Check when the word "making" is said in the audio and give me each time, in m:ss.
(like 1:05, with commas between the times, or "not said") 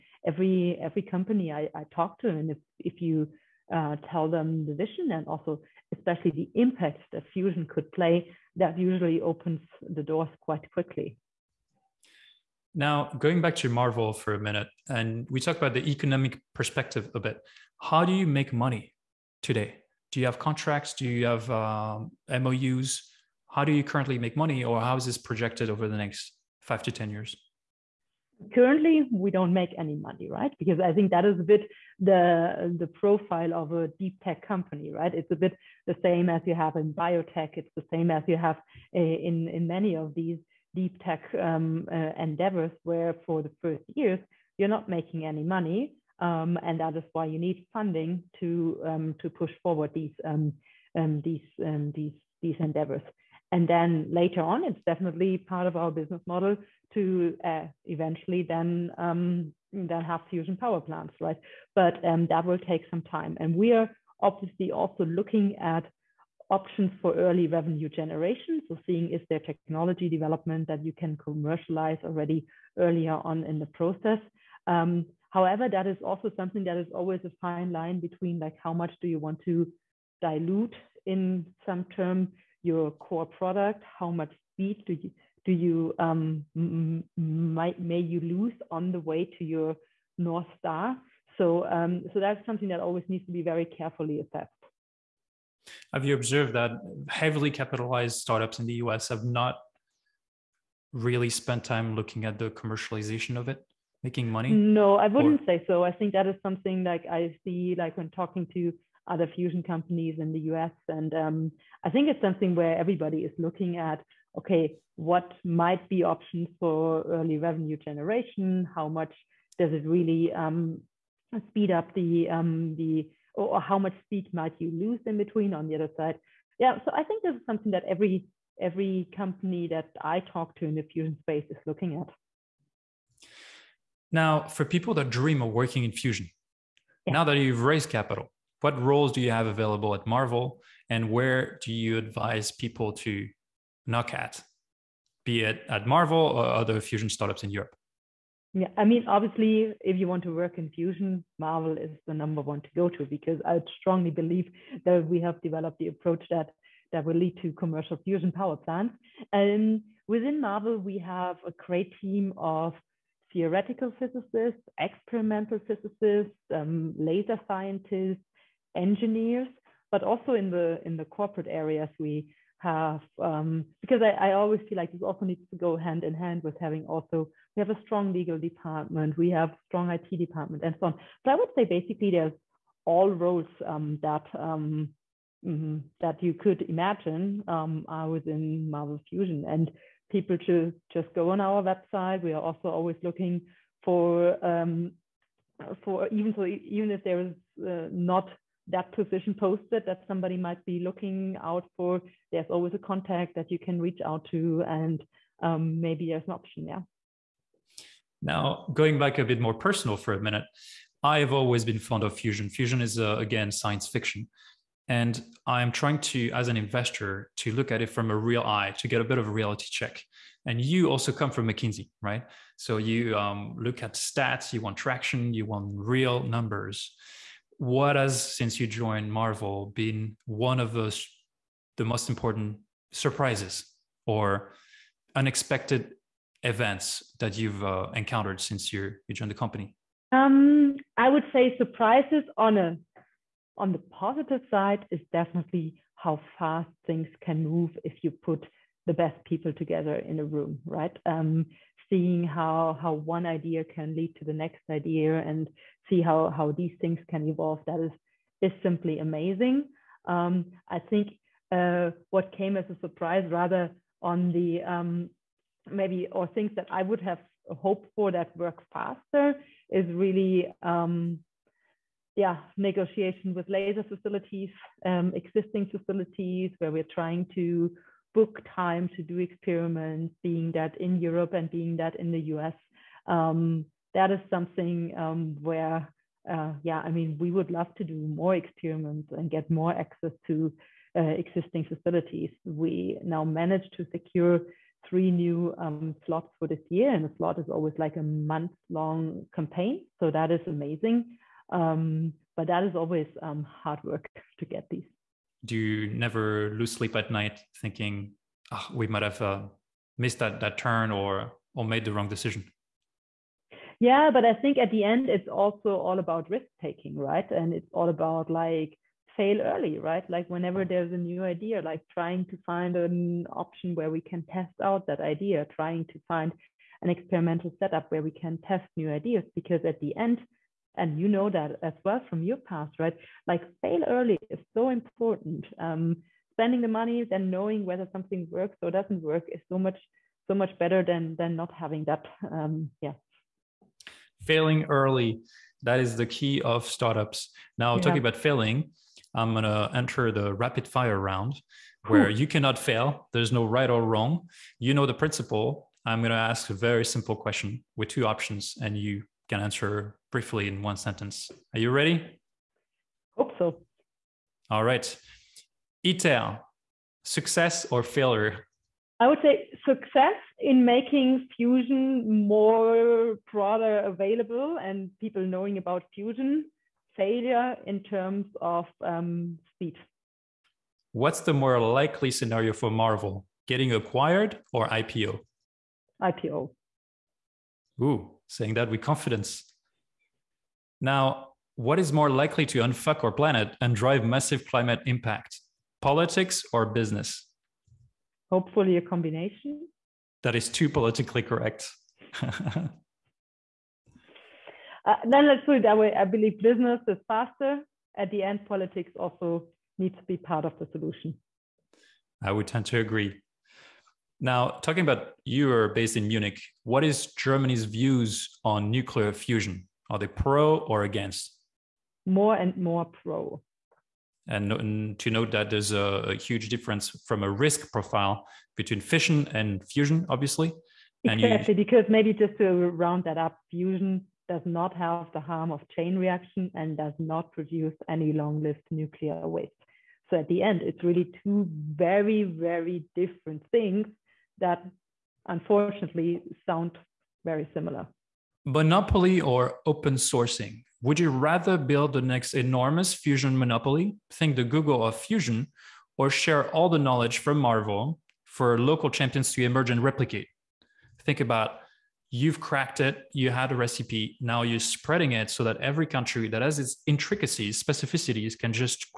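0:44, 1:44, 6:10.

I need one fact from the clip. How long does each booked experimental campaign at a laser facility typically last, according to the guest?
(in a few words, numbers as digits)
A month.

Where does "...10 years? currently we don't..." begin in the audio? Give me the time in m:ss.
0:26.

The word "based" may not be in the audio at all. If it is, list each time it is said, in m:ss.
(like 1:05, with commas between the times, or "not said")
6:55.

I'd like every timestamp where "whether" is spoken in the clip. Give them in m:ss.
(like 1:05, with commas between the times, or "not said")
5:37.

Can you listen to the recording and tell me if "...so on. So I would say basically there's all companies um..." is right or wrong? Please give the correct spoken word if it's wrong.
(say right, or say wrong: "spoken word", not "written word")
wrong: "roles", not "companies".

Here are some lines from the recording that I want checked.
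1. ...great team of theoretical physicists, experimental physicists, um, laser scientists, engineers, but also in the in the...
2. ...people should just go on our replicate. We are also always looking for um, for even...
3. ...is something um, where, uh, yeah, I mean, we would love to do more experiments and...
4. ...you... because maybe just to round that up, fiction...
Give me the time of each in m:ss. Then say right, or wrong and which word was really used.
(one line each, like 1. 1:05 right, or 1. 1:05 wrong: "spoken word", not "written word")
1. 2:41 right
2. 3:10 wrong: "website", not "replicate"
3. 4:44 right
4. 7:11 wrong: "fusion", not "fiction".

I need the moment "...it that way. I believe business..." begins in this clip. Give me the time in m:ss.
6:45.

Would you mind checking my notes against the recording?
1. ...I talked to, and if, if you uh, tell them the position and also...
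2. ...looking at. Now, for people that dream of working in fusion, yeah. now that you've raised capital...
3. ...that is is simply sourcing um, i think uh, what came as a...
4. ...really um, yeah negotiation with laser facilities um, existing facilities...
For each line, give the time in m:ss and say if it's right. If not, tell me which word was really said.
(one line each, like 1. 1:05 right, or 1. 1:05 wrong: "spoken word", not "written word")
1. 0:01 wrong: "vision", not "position"
2. 2:11 right
3. 4:17 wrong: "amazing", not "sourcing"
4. 4:29 right.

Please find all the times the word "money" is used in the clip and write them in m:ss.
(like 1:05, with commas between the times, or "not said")
0:18, 0:24, 0:29, 0:45, 1:44, 5:36.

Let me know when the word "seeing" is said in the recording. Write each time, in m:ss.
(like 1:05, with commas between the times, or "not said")
1:08, 4:11.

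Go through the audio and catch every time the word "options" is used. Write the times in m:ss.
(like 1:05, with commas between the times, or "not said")
1:06, 1:56, 3:26, 5:23, 5:58.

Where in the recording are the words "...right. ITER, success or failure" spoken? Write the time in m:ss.
6:04.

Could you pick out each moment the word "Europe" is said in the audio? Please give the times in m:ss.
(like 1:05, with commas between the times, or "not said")
2:27, 4:41.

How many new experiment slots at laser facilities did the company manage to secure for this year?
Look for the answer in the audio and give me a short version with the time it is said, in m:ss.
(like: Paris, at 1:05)
3, at 4:54.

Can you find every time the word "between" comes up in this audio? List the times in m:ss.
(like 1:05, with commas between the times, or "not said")
1:17, 2:05, 7:08.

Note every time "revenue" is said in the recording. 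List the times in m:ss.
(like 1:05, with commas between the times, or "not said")
1:07, 1:57.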